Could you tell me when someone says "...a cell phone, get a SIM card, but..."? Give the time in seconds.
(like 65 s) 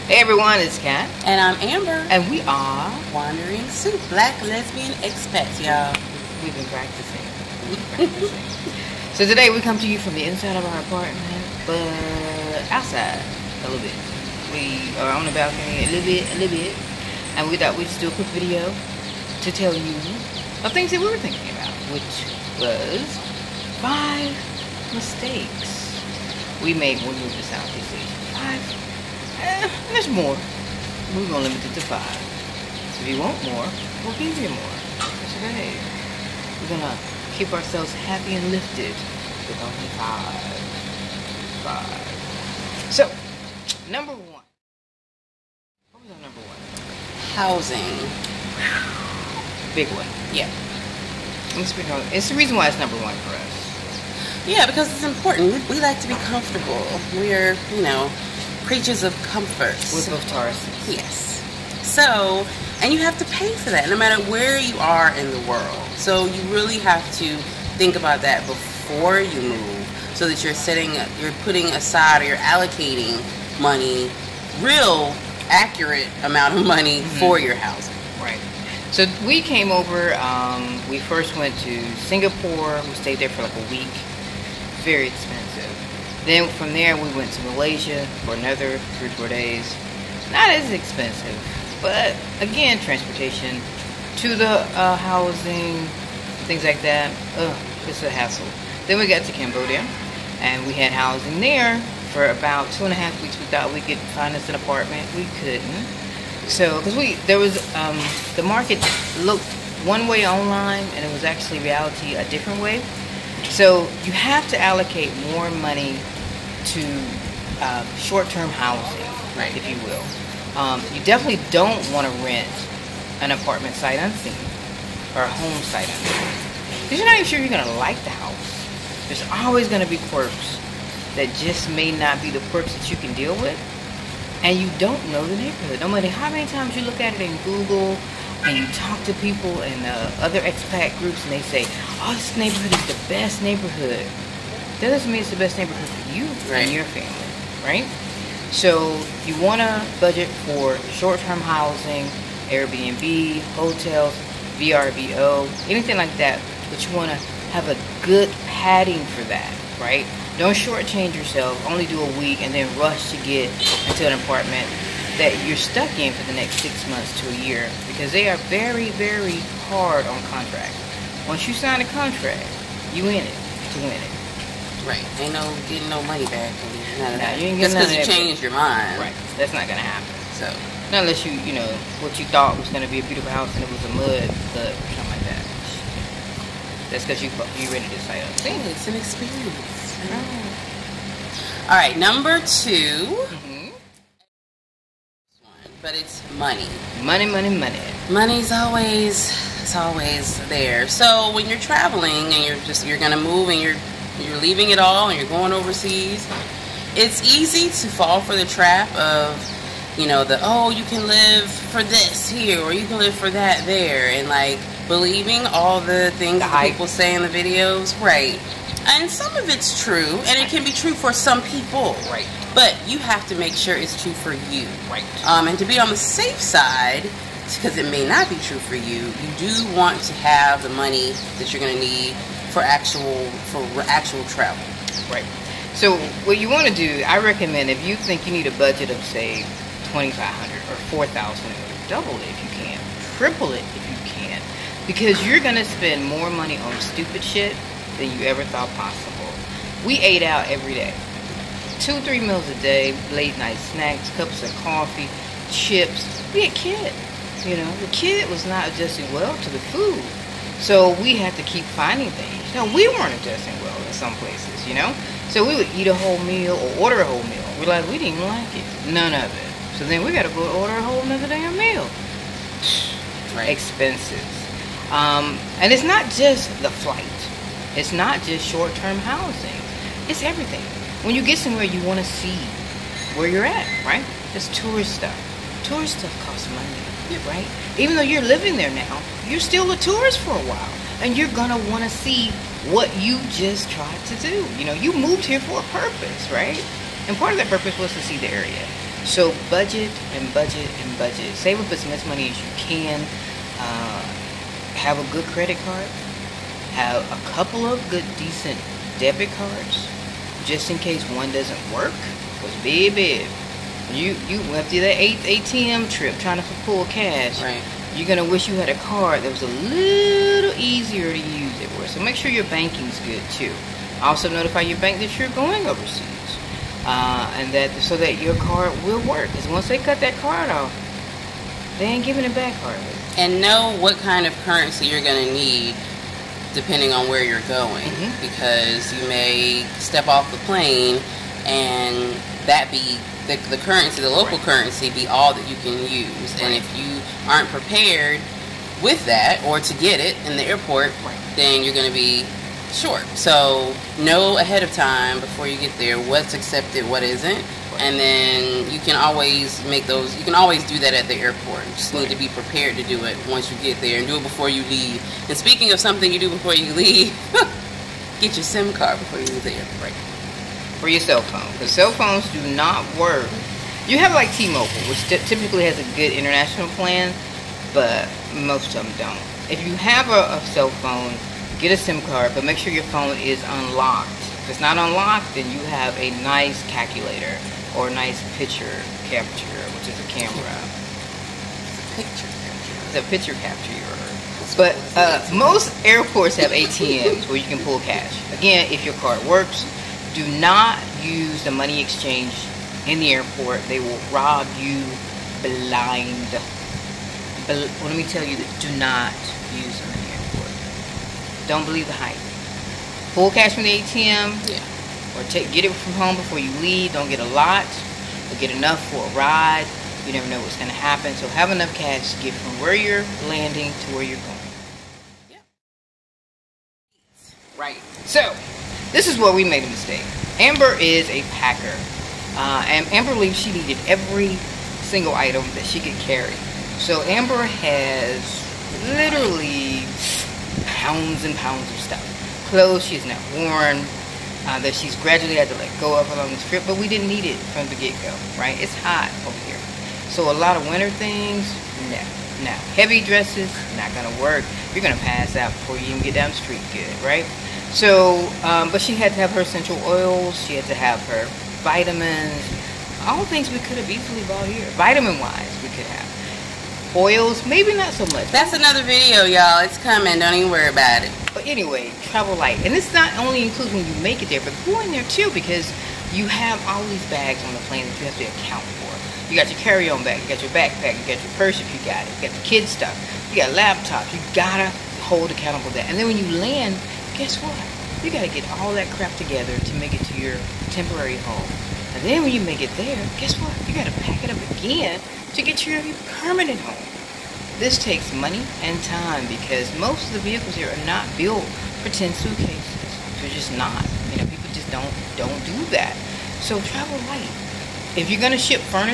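380 s.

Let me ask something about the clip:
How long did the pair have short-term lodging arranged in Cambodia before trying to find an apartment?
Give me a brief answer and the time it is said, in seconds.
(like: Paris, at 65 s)
2.5 weeks, at 102 s.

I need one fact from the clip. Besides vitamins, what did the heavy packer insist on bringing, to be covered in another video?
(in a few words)
essential oils.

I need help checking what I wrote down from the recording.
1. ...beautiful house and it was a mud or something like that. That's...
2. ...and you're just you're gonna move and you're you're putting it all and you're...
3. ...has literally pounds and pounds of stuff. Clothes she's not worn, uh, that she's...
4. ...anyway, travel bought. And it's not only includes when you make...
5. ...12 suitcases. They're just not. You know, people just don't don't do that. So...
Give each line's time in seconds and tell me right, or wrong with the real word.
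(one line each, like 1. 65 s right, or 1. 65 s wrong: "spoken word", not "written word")
1. 183 s right
2. 202 s wrong: "leaving", not "putting"
3. 437 s right
4. 471 s wrong: "light", not "bought"
5. 501 s wrong: "10", not "12".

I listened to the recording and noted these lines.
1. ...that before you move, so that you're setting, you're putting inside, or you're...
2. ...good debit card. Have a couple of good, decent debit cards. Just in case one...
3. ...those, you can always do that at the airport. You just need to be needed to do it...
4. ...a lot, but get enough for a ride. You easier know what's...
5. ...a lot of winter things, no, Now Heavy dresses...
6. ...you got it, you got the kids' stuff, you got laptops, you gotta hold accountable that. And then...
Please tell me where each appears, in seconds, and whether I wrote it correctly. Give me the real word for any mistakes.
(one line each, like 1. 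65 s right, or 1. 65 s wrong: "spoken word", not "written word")
1. 68 s wrong: "aside", not "inside"
2. 305 s wrong: "credit", not "debit"
3. 359 s wrong: "prepared", not "needed"
4. 417 s wrong: "never", not "easier"
5. 450 s right
6. 481 s right.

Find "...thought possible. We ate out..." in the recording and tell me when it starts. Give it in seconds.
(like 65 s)
248 s.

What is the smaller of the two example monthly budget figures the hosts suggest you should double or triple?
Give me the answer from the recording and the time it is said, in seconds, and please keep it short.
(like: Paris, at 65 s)
2500, at 239 s.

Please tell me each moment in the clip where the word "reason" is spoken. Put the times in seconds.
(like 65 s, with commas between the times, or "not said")
52 s.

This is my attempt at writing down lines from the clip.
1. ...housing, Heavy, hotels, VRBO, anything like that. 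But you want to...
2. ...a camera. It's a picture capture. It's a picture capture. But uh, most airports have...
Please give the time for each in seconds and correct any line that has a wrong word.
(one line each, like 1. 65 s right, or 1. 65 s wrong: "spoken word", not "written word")
1. 151 s wrong: "Airbnb", not "Heavy"
2. 389 s right.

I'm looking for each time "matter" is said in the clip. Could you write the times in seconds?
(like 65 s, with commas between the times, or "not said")
63 s, 135 s.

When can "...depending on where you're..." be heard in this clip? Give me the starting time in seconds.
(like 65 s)
336 s.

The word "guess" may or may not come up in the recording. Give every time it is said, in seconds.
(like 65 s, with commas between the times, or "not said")
487 s, 493 s.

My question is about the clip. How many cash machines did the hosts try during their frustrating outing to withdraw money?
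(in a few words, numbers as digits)
8.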